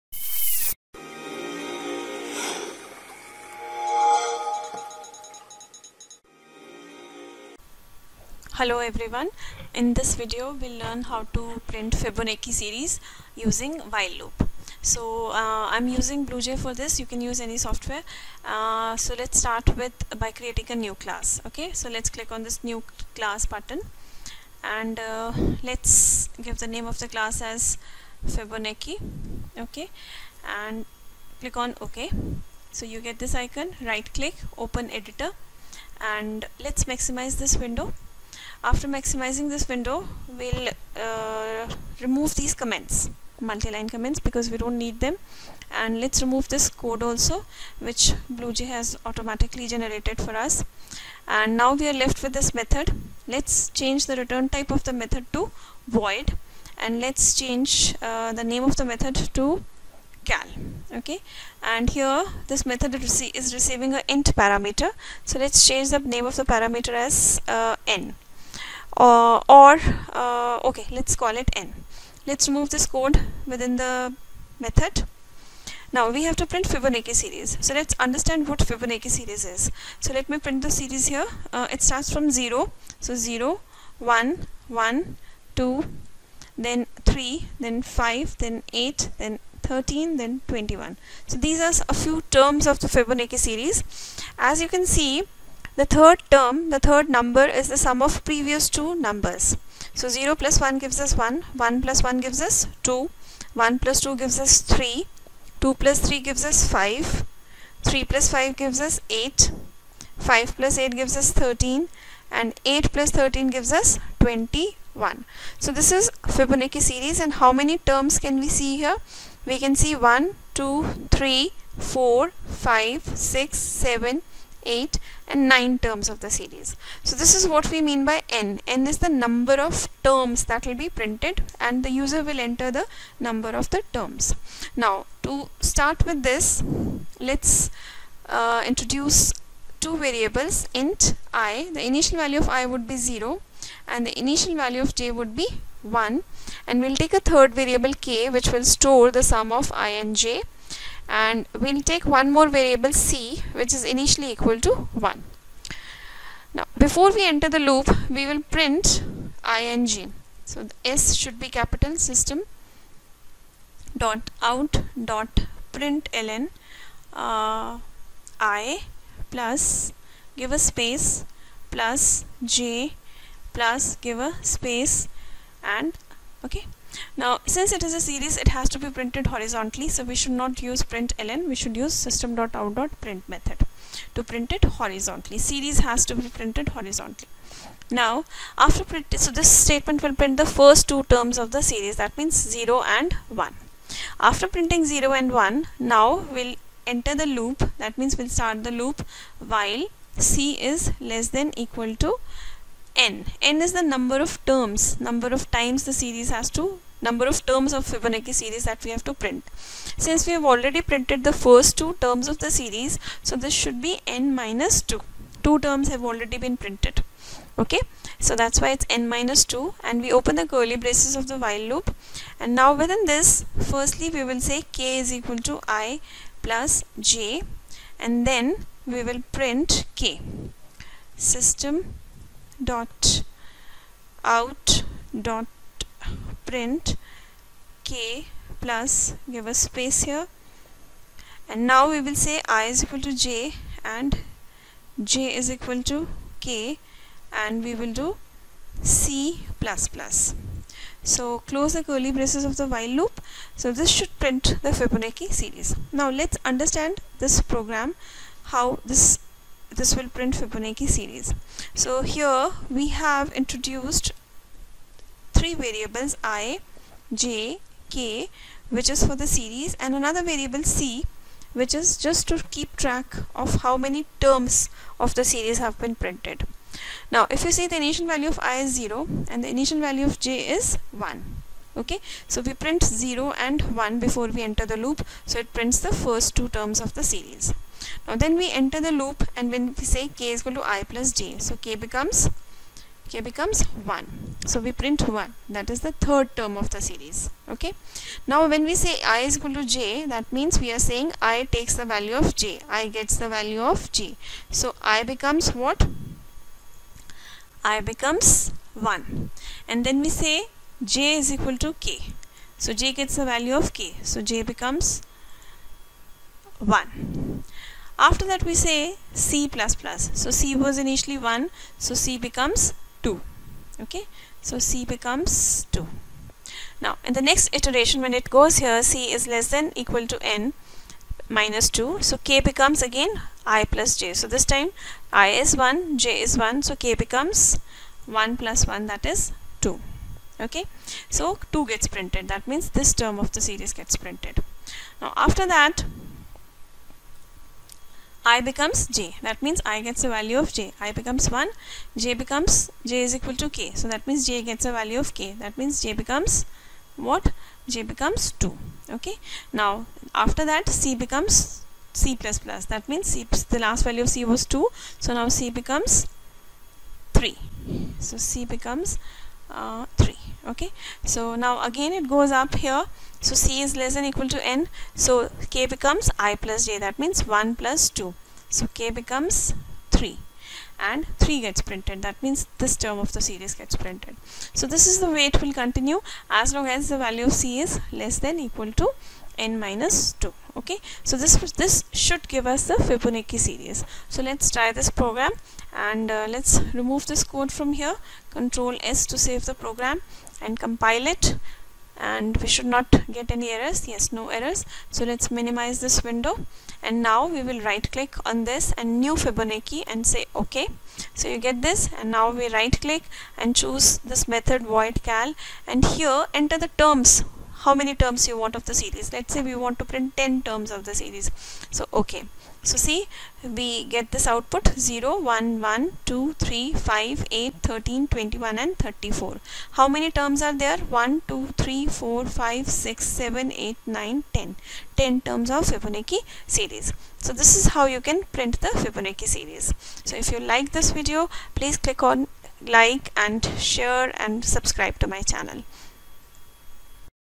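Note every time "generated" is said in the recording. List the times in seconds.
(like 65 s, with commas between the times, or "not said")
49 s.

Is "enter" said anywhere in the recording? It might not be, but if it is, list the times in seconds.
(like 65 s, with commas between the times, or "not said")
132 s, 157 s, 196 s, 284 s, 288 s, 416 s.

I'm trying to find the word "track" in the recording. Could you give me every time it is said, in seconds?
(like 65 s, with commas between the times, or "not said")
272 s.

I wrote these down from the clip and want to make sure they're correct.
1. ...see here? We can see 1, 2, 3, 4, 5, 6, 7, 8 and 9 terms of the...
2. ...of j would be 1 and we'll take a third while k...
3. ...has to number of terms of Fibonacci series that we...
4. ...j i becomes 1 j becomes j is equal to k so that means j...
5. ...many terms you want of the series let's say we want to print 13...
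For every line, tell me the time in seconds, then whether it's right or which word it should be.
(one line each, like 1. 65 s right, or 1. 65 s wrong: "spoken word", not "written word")
1. 118 s right
2. 144 s wrong: "variable", not "while"
3. 206 s right
4. 350 s right
5. 417 s wrong: "10", not "13".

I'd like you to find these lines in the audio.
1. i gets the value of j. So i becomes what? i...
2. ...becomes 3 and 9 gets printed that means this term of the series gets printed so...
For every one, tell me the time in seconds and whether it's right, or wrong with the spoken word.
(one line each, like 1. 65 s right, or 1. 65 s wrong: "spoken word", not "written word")
1. 302 s right
2. 379 s wrong: "3", not "9".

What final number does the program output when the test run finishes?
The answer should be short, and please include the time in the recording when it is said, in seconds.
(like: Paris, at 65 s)
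34, at 428 s.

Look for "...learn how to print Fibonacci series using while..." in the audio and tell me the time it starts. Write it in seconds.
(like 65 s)
10 s.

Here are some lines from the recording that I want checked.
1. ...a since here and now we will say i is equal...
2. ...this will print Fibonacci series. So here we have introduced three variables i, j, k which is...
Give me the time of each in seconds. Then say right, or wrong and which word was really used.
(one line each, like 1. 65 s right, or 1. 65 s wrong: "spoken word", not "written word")
1. 239 s wrong: "space", not "since"
2. 259 s right.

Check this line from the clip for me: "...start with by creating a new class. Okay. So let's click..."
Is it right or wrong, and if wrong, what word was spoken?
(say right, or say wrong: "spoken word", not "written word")
right.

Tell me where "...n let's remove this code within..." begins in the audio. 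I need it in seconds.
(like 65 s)
71 s.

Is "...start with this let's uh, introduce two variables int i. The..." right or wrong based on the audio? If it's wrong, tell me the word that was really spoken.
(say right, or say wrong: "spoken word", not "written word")
right.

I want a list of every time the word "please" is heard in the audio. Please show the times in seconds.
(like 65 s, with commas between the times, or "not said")
441 s.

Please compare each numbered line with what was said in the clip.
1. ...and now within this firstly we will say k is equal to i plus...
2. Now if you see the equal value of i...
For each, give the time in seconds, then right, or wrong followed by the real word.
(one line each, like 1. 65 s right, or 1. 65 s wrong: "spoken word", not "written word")
1. 222 s right
2. 277 s wrong: "initial", not "equal".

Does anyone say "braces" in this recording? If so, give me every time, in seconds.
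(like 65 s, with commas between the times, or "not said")
220 s, 252 s.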